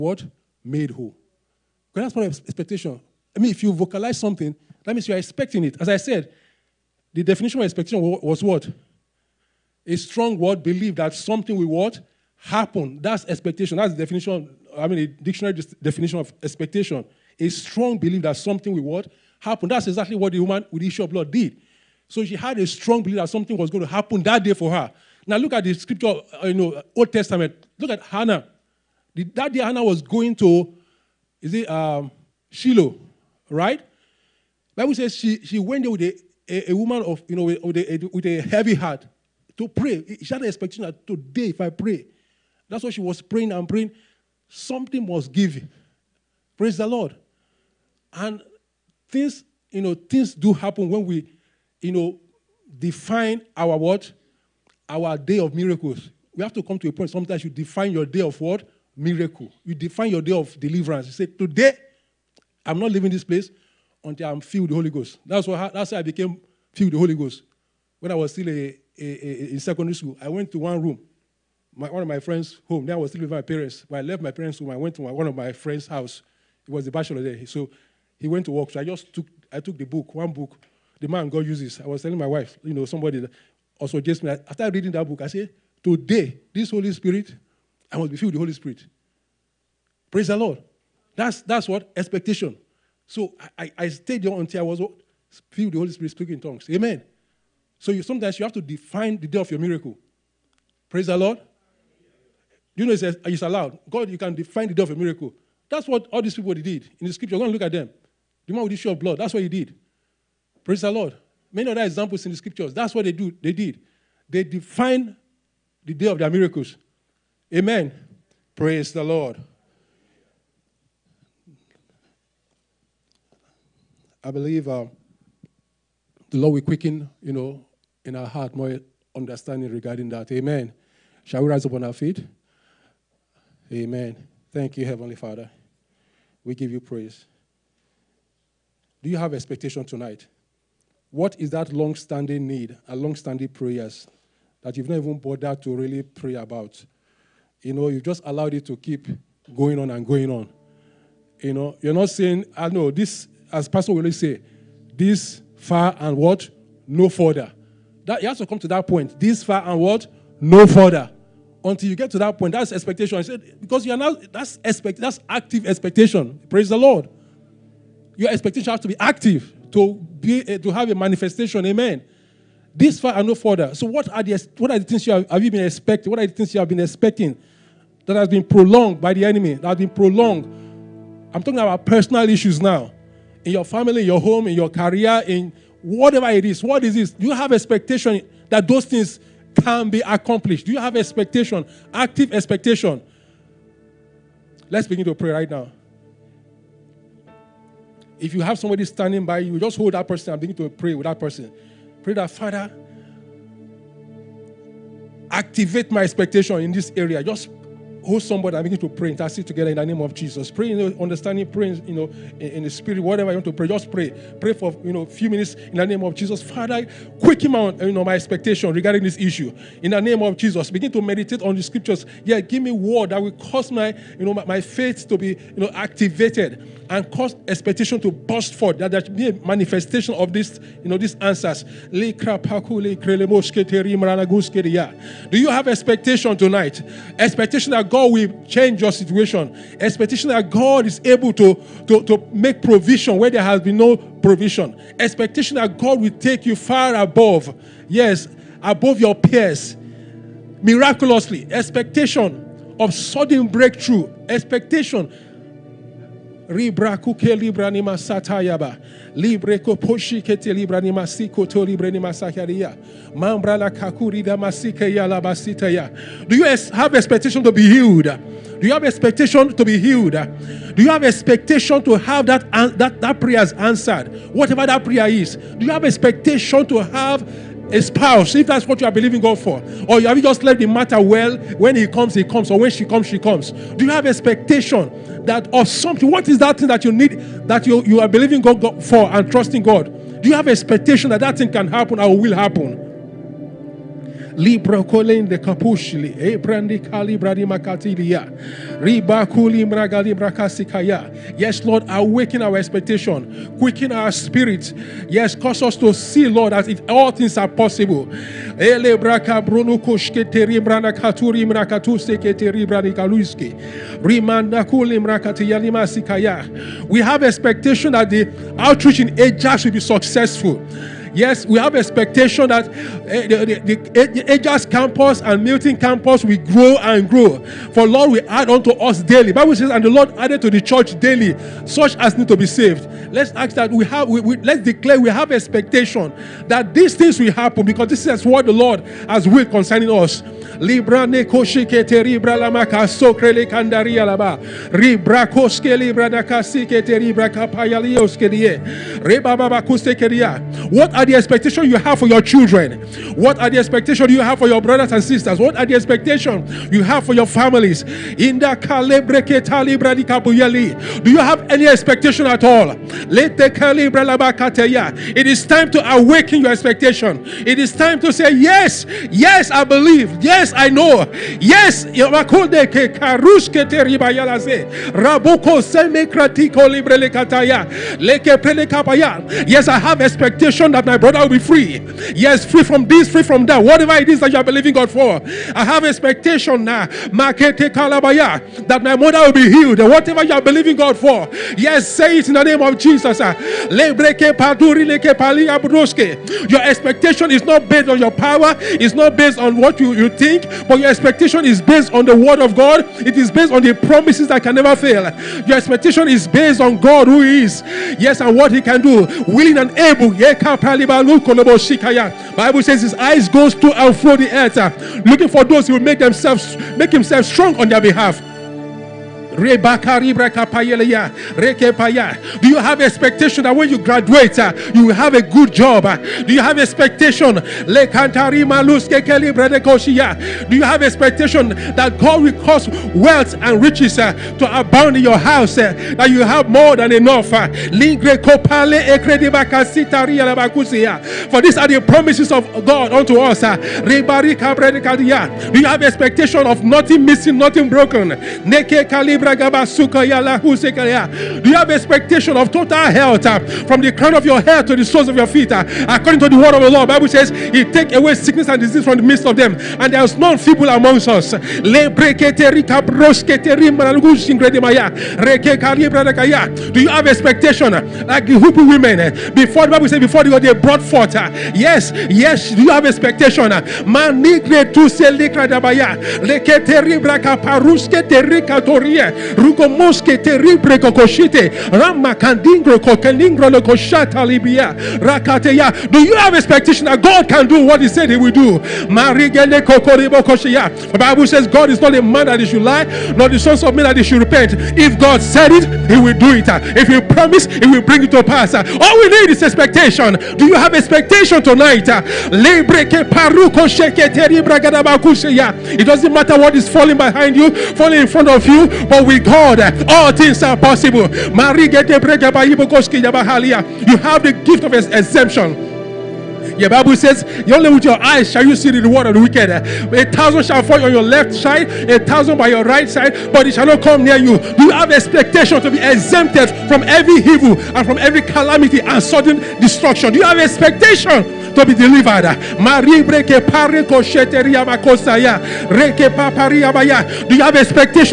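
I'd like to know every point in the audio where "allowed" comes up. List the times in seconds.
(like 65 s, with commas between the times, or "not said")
103 s, 148 s.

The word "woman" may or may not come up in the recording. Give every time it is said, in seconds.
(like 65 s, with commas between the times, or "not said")
20 s, 36 s.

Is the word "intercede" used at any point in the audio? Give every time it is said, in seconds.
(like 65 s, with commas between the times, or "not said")
209 s.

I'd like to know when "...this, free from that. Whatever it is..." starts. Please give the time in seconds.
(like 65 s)
382 s.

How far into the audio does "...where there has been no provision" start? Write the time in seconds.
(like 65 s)
243 s.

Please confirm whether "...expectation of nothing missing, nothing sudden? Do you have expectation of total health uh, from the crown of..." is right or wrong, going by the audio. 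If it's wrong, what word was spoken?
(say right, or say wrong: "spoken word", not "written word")
wrong: "broken", not "sudden".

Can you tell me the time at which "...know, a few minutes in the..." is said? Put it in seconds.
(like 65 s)
214 s.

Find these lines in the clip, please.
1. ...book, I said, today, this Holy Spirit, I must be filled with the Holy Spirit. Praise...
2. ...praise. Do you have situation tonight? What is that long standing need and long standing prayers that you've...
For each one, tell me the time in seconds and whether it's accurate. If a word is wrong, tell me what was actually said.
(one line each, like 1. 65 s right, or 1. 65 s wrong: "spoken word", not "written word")
1. 85 s right
2. 136 s wrong: "expectation", not "situation".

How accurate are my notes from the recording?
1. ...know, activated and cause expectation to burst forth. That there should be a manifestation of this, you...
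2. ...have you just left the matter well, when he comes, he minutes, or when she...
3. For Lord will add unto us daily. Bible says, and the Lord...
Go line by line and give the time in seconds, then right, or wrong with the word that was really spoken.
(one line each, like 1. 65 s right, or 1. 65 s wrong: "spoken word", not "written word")
1. 225 s right
2. 280 s wrong: "comes", not "minutes"
3. 327 s right.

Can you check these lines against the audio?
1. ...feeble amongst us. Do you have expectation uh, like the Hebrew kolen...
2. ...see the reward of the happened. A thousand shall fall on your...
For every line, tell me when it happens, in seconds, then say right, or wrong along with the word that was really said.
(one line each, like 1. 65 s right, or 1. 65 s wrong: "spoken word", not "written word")
1. 460 s wrong: "women", not "kolen"
2. 518 s wrong: "wicked", not "happened".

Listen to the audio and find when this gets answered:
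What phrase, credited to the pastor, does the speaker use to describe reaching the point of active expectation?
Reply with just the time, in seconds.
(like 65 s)
172 s.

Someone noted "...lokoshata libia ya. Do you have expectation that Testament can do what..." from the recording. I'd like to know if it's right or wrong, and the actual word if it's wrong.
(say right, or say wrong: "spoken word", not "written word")
wrong: "God", not "Testament".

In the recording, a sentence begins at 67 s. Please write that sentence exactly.
When I was still a, a, a, in secondary school, I went to one room, my, one of my friends' home.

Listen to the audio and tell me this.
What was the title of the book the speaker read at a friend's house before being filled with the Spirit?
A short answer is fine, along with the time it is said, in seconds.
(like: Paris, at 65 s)
The Man God Uses, at 81 s.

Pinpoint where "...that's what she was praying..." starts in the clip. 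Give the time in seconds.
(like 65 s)
42 s.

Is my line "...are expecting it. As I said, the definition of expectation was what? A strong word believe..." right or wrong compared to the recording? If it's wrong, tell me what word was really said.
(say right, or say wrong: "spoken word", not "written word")
right.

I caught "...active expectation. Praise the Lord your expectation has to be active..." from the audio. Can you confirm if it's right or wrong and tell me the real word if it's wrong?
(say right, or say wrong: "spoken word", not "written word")
right.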